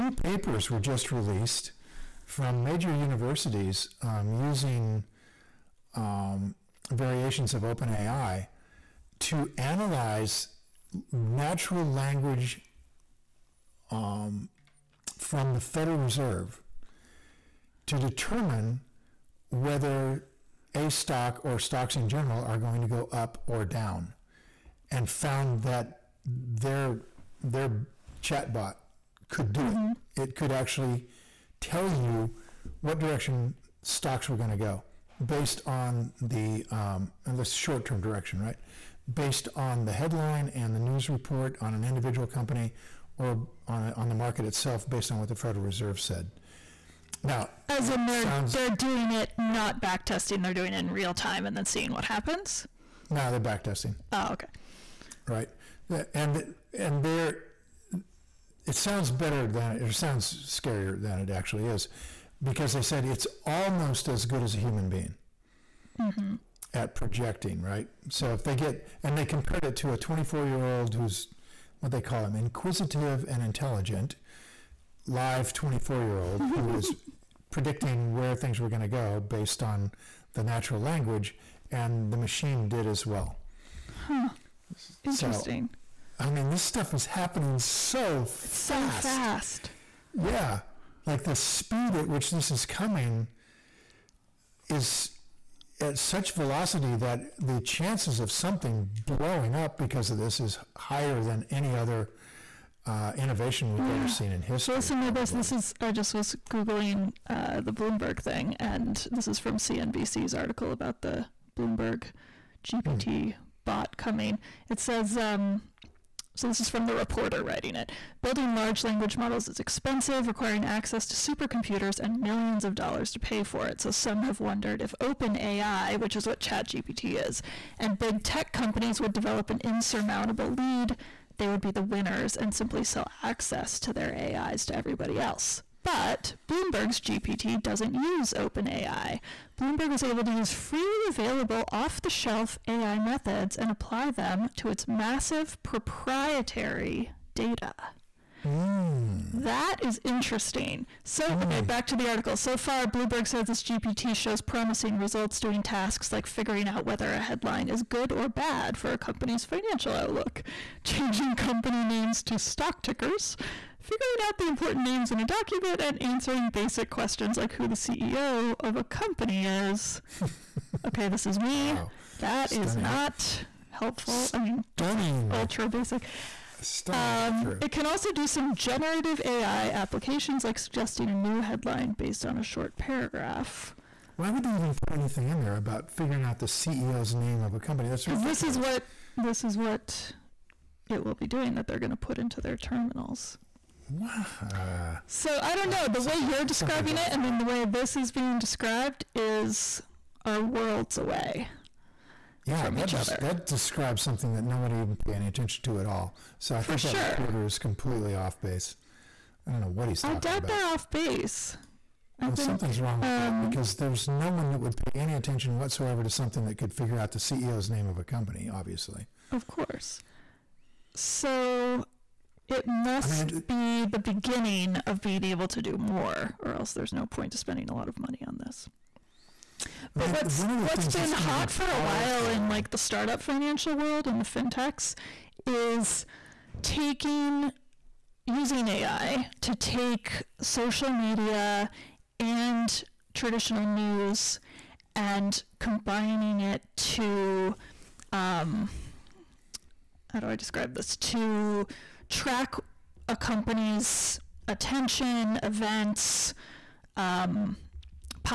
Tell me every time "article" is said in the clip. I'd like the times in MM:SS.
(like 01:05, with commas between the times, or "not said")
01:50, 02:32.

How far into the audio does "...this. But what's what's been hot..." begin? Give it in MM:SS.
03:48.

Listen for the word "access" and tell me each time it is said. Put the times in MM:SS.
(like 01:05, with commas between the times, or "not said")
02:00, 02:13.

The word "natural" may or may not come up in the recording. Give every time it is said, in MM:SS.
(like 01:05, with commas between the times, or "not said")
00:11, 01:20.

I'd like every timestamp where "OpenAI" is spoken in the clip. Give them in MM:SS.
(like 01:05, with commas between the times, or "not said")
00:07, 02:05, 02:18.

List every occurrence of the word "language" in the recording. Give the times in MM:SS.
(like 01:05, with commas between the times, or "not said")
00:11, 01:20, 01:58.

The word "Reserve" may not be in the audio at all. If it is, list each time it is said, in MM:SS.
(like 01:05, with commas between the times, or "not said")
00:15, 00:45.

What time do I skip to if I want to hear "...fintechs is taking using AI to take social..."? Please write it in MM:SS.
03:54.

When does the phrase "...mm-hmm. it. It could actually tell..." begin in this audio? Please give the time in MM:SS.
00:29.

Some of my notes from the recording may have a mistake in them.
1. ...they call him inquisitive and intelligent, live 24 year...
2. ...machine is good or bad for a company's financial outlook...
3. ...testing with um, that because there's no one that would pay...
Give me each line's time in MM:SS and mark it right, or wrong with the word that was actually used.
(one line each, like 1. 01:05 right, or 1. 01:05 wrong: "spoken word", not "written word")
1. 01:11 right
2. 02:37 wrong: "headline", not "machine"
3. 03:32 wrong: "wrong", not "testing".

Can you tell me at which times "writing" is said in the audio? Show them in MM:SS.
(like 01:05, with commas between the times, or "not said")
01:57.